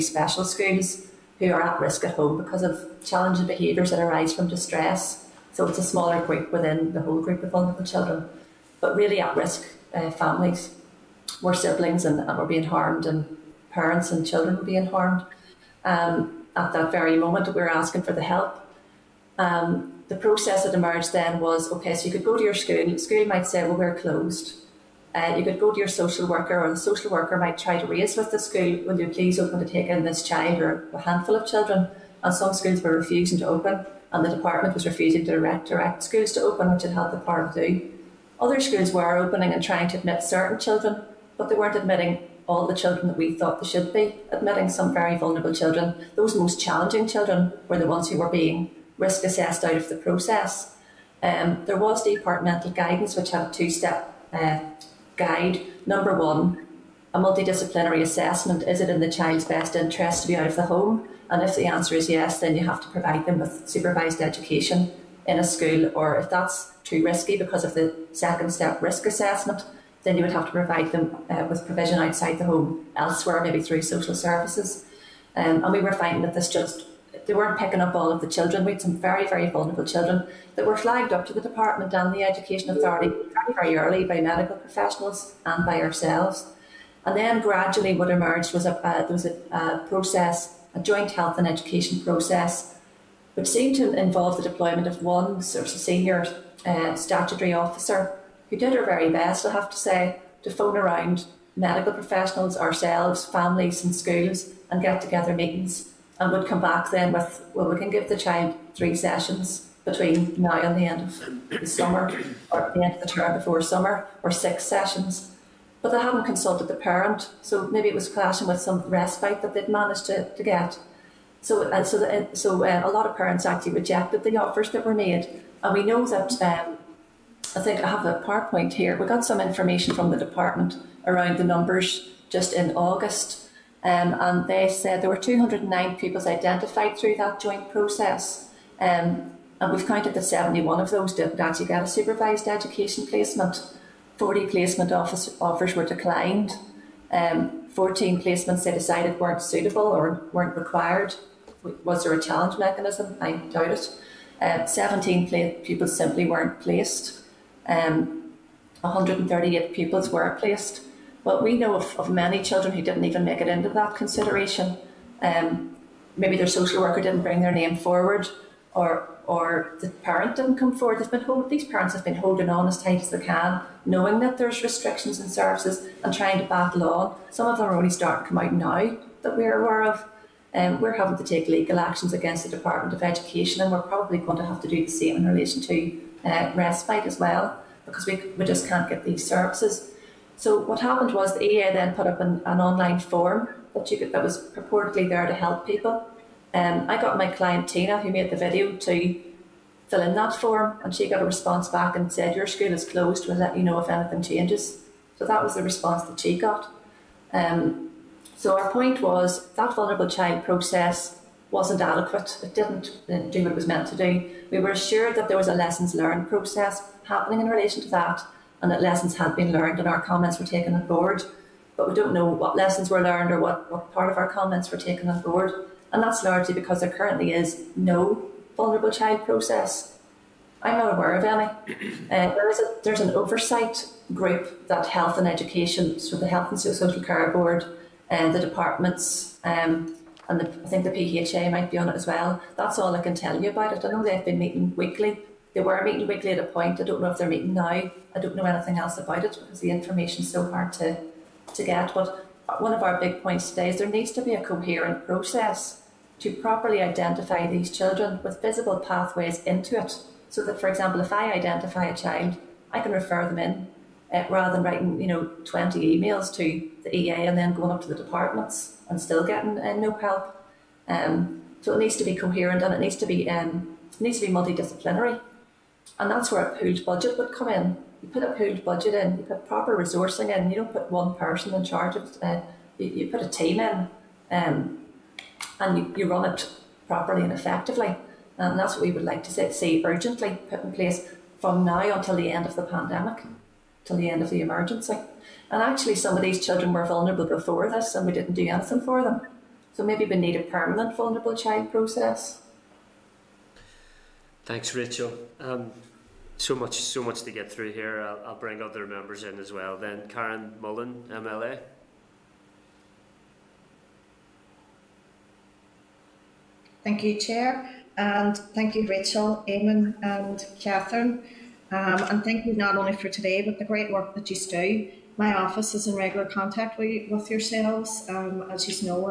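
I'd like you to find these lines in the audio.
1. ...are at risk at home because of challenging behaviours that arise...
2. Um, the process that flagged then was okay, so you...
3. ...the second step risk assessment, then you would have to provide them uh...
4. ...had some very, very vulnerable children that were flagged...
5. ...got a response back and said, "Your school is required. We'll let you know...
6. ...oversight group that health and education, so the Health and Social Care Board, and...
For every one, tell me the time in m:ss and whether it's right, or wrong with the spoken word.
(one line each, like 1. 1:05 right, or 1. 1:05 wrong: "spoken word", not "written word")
1. 0:01 right
2. 0:19 wrong: "emerged", not "flagged"
3. 1:07 right
4. 1:18 right
5. 3:21 wrong: "closed", not "required"
6. 3:53 right.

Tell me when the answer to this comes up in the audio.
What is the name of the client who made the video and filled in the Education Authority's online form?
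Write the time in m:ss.
3:17.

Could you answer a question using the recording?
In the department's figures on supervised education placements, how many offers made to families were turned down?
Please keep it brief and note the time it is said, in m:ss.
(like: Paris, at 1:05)
40, at 2:24.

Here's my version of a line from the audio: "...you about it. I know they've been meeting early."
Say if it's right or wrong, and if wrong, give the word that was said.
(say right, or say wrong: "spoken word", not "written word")
wrong: "weekly", not "early".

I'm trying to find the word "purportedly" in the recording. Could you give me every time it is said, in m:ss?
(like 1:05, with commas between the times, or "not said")
3:14.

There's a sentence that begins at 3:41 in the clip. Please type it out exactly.
But we don't know what lessons were learned or what, what part of our comments were taken on board.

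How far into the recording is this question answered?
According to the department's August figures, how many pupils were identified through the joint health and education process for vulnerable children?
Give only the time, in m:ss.
2:15.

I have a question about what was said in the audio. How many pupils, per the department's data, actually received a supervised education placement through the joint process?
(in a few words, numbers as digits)
138.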